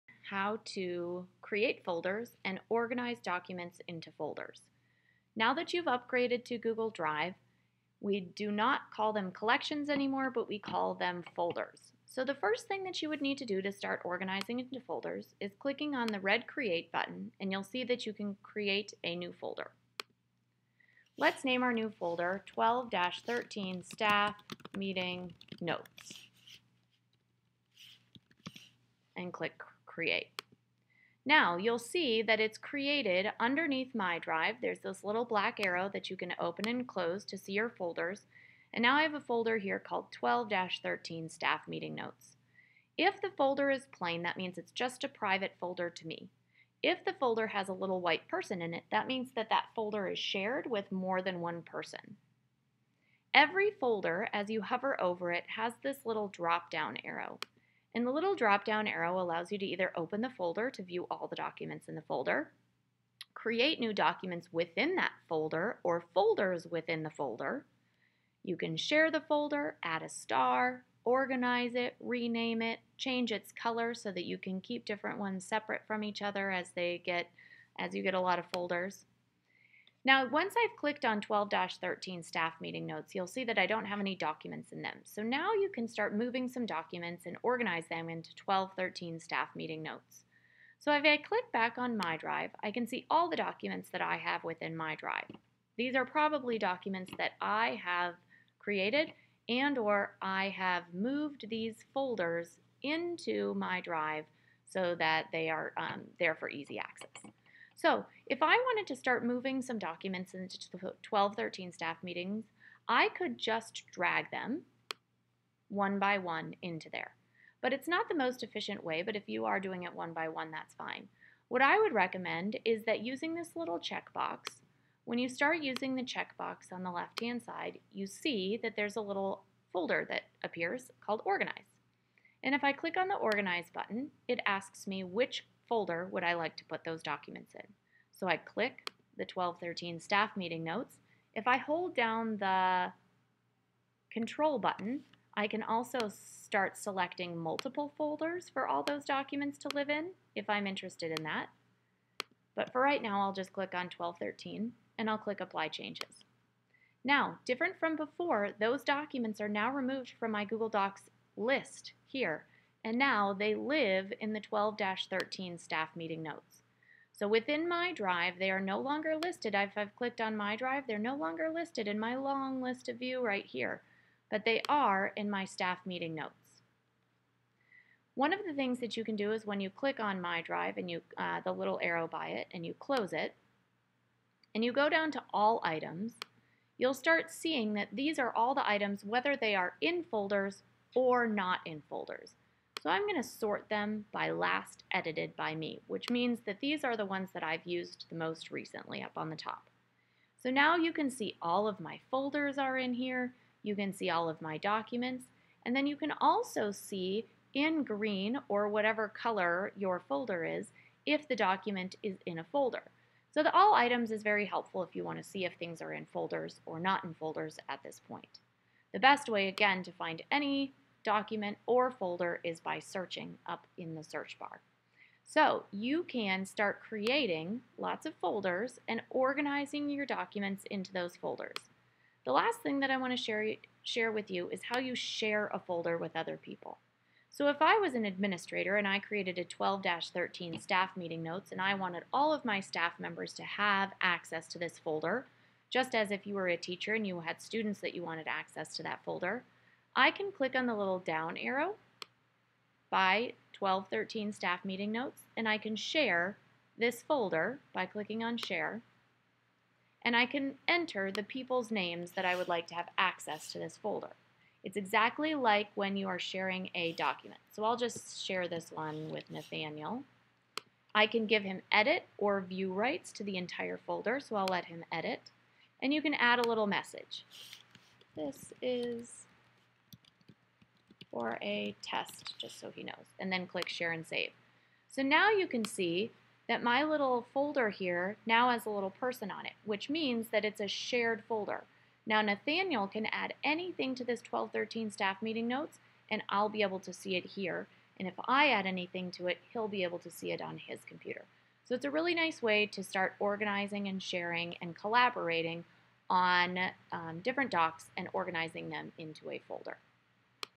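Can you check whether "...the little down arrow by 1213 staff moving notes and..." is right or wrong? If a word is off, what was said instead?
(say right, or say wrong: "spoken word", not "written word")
wrong: "meeting", not "moving".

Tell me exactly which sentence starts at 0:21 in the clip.
Let's name our new folder 12-13 Staff Meeting Notes and click create.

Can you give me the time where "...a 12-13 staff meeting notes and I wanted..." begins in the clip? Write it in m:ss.
3:59.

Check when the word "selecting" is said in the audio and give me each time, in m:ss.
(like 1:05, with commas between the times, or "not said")
2:26.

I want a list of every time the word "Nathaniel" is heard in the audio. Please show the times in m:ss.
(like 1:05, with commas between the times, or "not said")
4:29, 4:52.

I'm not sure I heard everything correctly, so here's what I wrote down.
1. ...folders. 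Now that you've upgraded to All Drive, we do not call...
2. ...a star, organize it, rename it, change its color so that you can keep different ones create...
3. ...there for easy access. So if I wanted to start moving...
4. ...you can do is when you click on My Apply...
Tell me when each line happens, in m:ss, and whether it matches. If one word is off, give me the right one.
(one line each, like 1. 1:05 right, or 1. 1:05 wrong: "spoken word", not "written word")
1. 0:04 wrong: "Google", not "All"
2. 1:10 wrong: "separate", not "create"
3. 1:46 right
4. 2:58 wrong: "Drive", not "Apply".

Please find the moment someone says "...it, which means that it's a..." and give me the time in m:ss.
4:49.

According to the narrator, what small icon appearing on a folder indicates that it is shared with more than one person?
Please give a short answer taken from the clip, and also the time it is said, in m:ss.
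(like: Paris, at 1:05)
a little white person, at 0:47.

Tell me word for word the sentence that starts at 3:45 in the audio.
So you can start creating lots of folders and organizing your documents into those folders.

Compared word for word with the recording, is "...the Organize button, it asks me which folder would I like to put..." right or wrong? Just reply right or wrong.
right.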